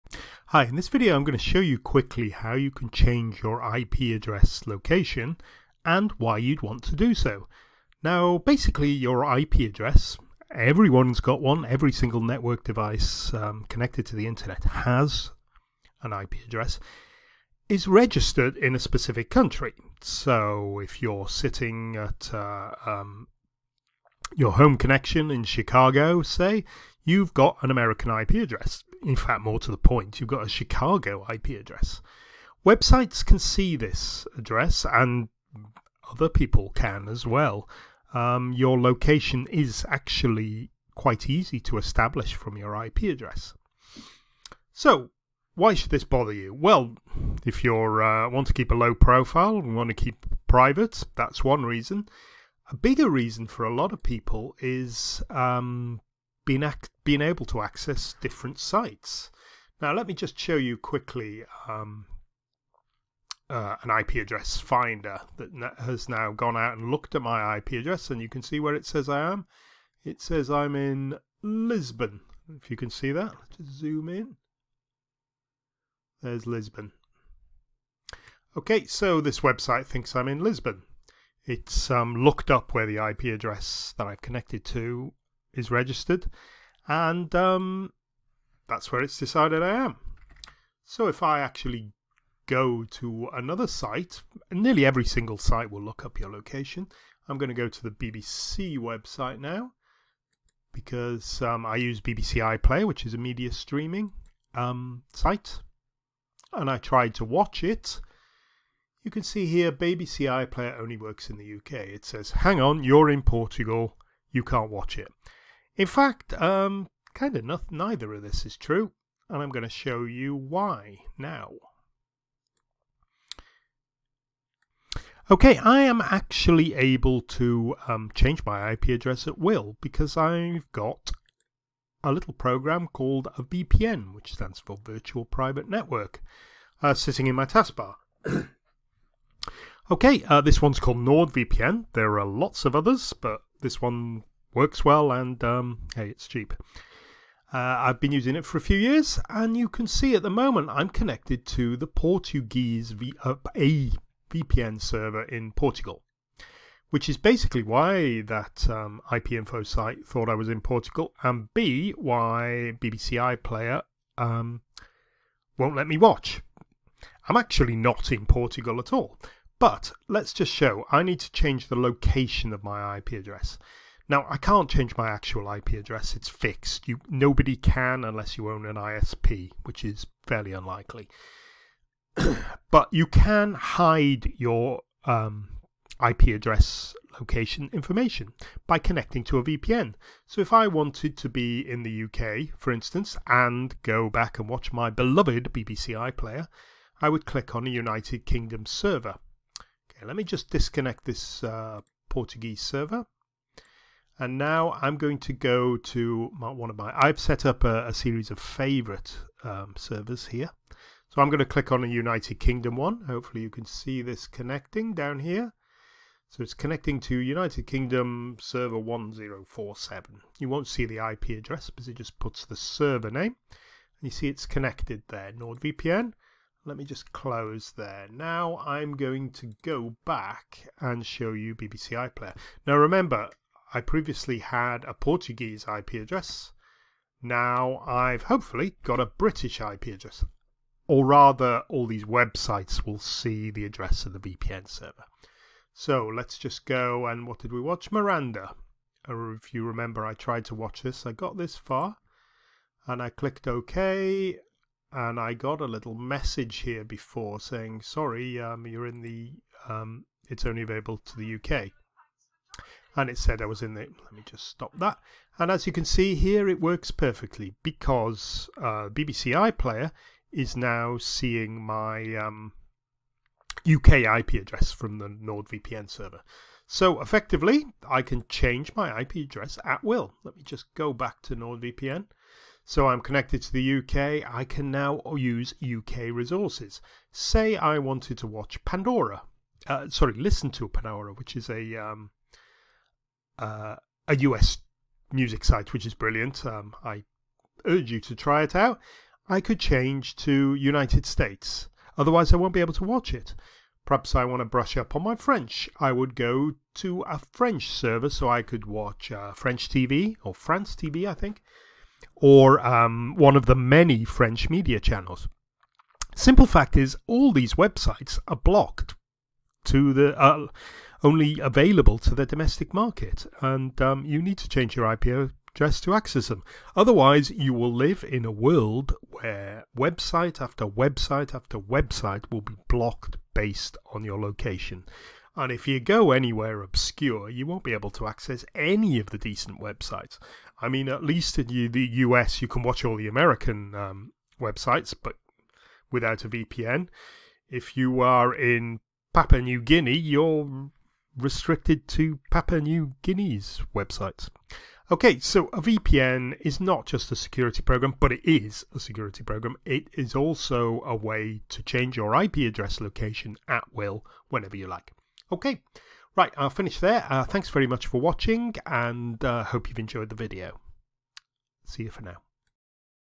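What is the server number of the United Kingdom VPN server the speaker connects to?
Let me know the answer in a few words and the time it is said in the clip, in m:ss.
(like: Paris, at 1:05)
1047, at 3:38.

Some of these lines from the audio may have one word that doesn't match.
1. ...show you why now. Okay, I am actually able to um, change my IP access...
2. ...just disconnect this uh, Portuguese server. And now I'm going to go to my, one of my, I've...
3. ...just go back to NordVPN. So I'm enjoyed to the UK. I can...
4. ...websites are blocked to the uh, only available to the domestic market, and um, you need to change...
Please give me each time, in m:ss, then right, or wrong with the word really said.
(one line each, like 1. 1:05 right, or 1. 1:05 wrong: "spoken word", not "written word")
1. 1:59 wrong: "address", not "access"
2. 3:20 right
3. 4:40 wrong: "connected", not "enjoyed"
4. 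5:17 right.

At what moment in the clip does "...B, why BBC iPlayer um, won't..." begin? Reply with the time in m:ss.
2:41.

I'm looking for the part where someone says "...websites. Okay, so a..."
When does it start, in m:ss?
5:53.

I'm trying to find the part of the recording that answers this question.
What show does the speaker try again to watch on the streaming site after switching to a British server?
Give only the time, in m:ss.
4:07.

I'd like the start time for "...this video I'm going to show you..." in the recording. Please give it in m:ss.
0:00.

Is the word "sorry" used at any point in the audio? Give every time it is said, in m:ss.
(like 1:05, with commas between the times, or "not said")
4:17, 4:49.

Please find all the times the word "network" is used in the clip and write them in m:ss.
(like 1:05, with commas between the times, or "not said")
0:12, 2:15.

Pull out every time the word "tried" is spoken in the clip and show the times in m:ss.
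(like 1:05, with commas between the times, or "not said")
1:46, 4:10.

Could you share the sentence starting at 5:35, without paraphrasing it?
And if you go anywhere obscure, you won't be able to access any of the decent websites.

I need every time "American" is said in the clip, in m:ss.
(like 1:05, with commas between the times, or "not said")
0:27, 5:43.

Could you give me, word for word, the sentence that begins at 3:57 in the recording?
Now I've hopefully got a British IP address.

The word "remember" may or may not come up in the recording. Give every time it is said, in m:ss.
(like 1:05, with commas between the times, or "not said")
3:52, 4:09.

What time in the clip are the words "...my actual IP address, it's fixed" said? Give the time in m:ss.
2:54.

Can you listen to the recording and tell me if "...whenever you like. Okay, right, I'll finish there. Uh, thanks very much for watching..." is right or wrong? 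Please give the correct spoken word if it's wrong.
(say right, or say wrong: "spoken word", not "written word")
right.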